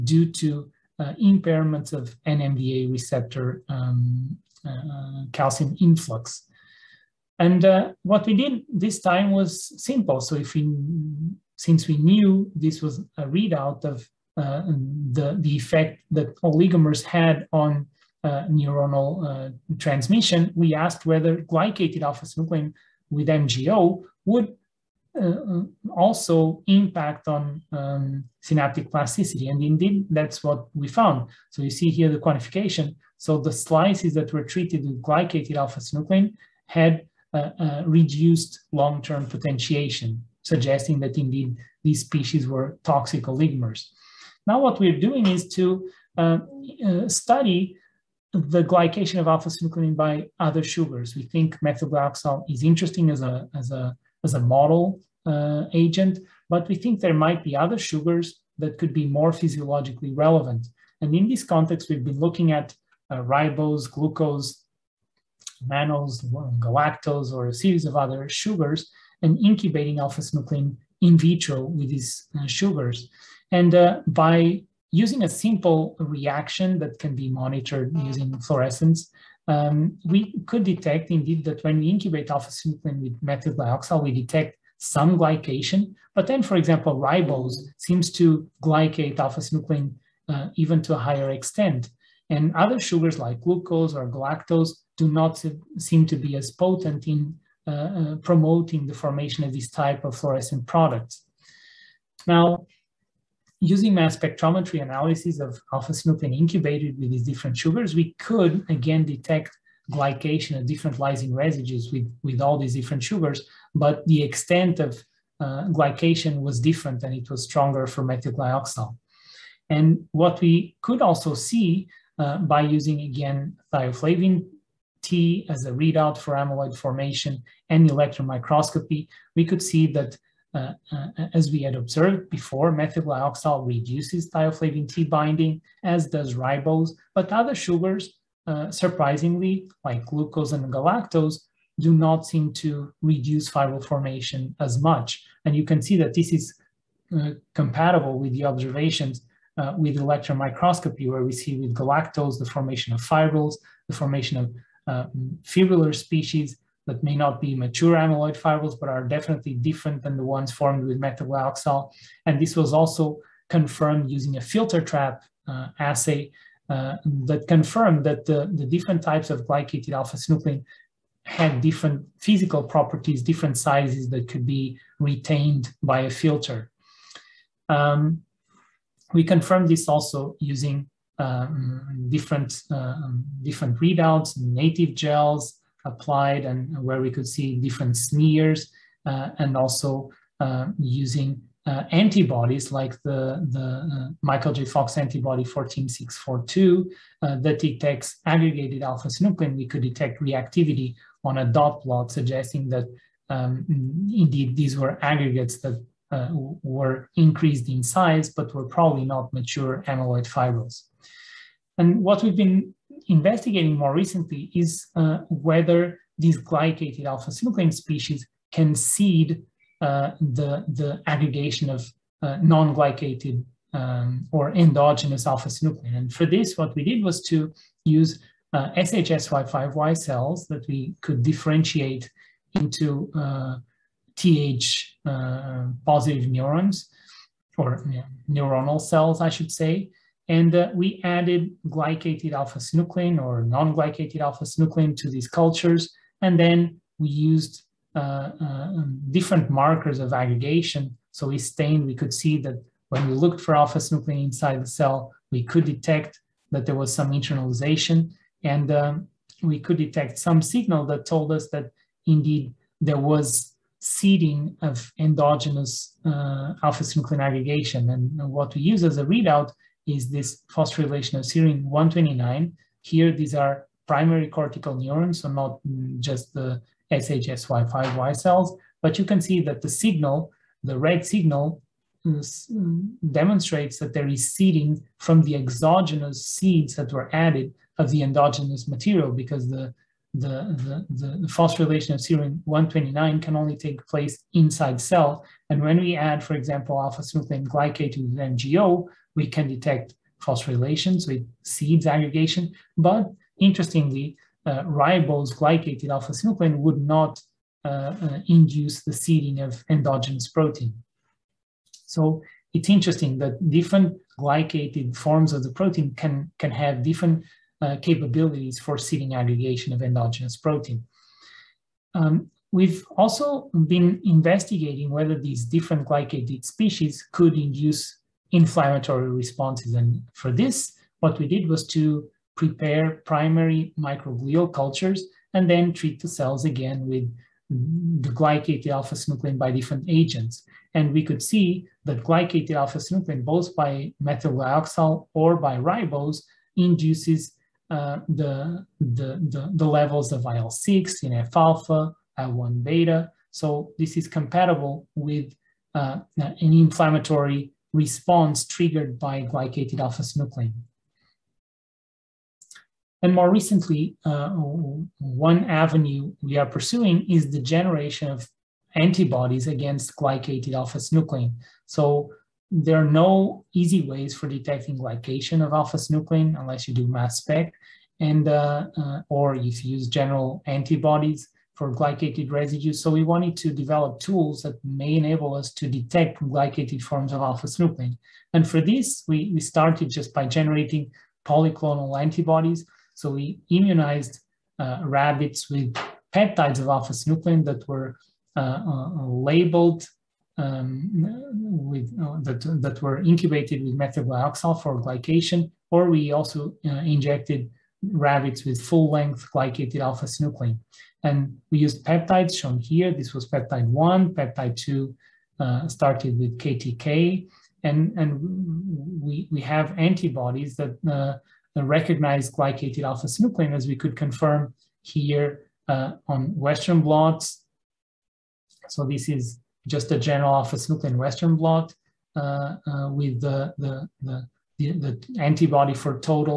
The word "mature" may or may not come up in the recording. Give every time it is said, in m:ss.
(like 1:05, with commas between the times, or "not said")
2:37, 3:29.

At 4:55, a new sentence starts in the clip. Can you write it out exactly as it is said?
And when we add, for example, alpha-synuclein glycate to the MGO, we can detect phosphorylations with seeds aggregation.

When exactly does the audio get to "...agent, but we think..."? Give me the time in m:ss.
0:55.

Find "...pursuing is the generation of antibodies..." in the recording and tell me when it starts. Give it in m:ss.
6:06.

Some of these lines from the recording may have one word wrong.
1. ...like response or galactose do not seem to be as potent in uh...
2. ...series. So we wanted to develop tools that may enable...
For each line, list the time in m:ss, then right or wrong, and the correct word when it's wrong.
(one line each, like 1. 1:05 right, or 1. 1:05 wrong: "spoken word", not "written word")
1. 1:33 wrong: "glucose", not "response"
2. 6:22 wrong: "residues", not "series".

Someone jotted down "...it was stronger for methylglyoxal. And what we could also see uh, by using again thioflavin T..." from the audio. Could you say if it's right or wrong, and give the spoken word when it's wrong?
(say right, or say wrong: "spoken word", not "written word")
right.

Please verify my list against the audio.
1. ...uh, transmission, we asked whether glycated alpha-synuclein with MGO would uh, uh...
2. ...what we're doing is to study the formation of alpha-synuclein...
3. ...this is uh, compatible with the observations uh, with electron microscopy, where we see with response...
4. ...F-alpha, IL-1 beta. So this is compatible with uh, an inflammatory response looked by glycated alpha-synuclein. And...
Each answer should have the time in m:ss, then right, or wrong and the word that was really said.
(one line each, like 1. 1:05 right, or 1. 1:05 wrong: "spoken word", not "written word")
1. 0:19 right
2. 0:44 wrong: "glycation", not "formation"
3. 2:26 wrong: "galactose", not "response"
4. 5:51 wrong: "triggered", not "looked".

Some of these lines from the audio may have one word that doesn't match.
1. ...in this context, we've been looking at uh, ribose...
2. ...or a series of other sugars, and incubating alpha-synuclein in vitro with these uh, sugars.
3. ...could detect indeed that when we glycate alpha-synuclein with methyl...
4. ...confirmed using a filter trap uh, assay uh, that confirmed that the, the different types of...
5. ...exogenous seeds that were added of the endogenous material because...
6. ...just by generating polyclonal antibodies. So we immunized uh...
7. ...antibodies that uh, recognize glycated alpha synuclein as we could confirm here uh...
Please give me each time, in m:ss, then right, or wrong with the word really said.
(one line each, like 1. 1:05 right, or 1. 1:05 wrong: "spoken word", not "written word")
1. 1:01 right
2. 1:07 right
3. 1:20 wrong: "incubate", not "glycate"
4. 2:43 right
5. 4:45 right
6. 6:29 right
7. 6:59 right.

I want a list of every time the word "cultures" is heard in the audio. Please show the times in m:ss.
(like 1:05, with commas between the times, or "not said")
4:05, 5:34.